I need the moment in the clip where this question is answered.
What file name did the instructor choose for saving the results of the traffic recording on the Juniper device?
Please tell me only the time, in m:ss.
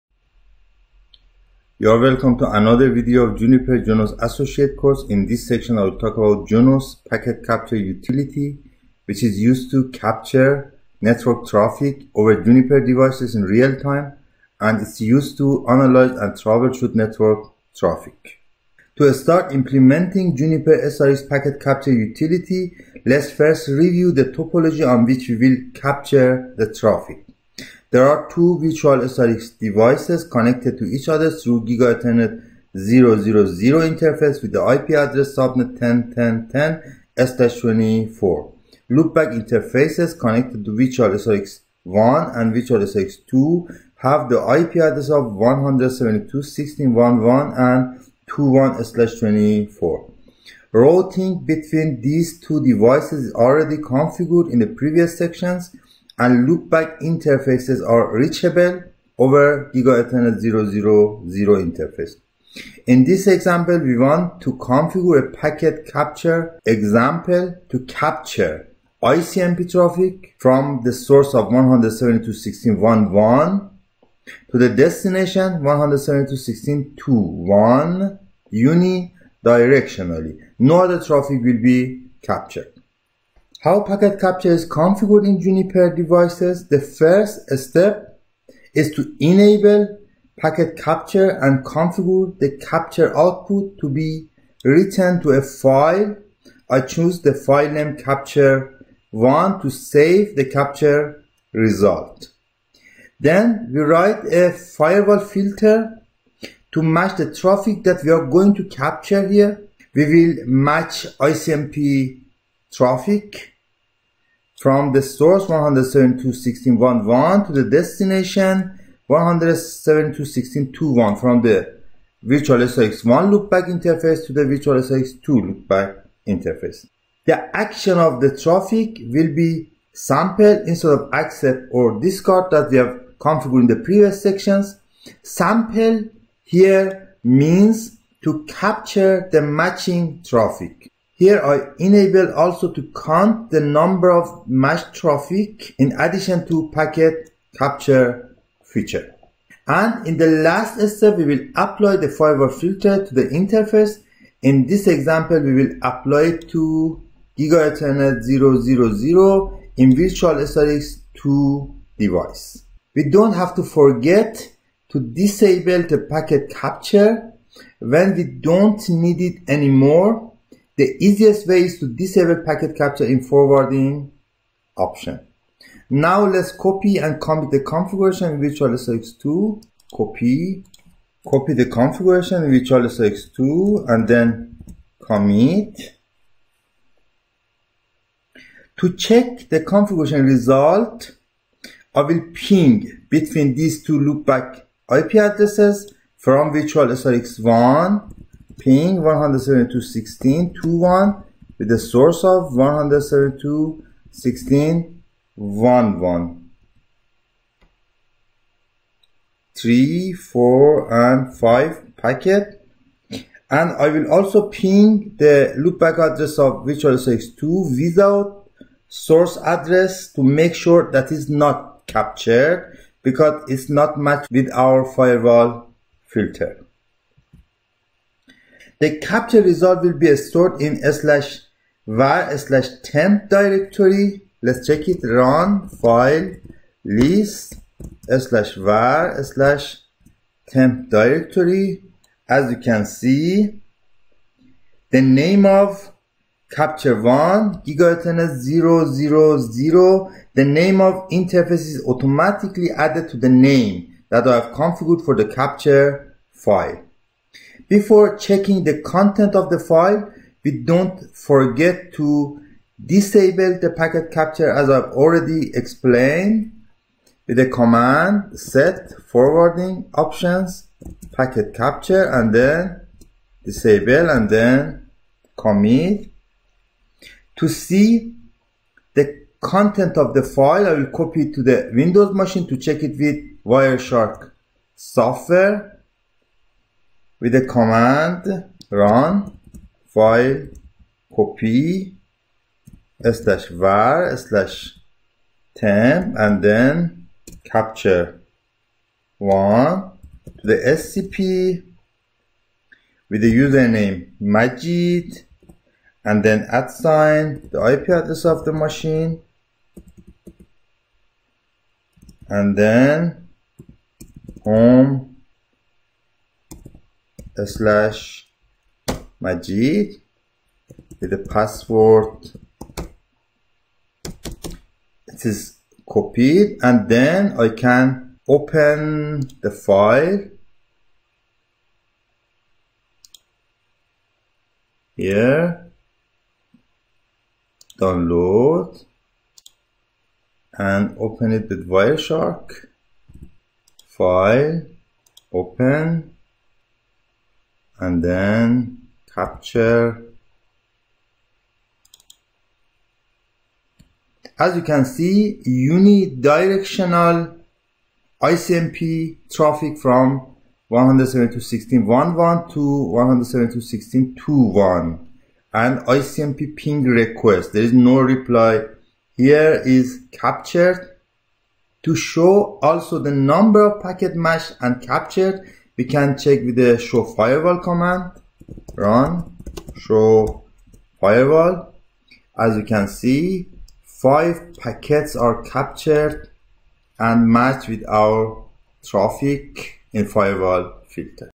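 1:37.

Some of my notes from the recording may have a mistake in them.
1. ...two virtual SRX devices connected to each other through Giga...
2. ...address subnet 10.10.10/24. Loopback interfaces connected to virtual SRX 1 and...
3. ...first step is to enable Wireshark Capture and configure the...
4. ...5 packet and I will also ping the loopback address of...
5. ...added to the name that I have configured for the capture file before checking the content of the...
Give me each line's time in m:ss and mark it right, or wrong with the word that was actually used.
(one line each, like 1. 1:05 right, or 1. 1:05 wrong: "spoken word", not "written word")
1. 0:28 right
2. 0:34 right
3. 1:26 wrong: "Packet", not "Wireshark"
4. 3:31 right
5. 4:12 right.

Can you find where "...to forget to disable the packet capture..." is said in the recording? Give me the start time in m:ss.
2:43.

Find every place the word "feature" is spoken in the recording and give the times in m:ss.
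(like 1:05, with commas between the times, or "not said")
2:28.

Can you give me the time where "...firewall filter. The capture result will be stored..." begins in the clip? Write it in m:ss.
3:44.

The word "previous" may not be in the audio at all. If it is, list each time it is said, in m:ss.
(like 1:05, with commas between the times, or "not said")
0:54, 2:13.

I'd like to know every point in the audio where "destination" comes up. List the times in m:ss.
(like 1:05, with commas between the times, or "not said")
1:14, 1:57.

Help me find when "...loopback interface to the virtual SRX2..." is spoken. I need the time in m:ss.
2:03.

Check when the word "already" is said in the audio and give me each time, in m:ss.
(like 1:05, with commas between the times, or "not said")
0:53, 4:25.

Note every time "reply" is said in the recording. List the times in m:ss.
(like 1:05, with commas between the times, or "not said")
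6:07.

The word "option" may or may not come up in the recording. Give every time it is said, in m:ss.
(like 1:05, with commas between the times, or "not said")
2:54, 4:29.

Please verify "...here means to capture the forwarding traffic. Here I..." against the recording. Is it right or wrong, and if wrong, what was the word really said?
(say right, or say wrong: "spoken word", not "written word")
wrong: "matching", not "forwarding".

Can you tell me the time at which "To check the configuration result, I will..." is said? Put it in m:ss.
3:08.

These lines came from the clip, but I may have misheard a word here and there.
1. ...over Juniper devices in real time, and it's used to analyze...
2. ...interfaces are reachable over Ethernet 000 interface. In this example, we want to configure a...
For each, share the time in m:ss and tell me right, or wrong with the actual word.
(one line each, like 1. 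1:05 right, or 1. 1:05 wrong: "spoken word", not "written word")
1. 0:12 right
2. 0:57 right.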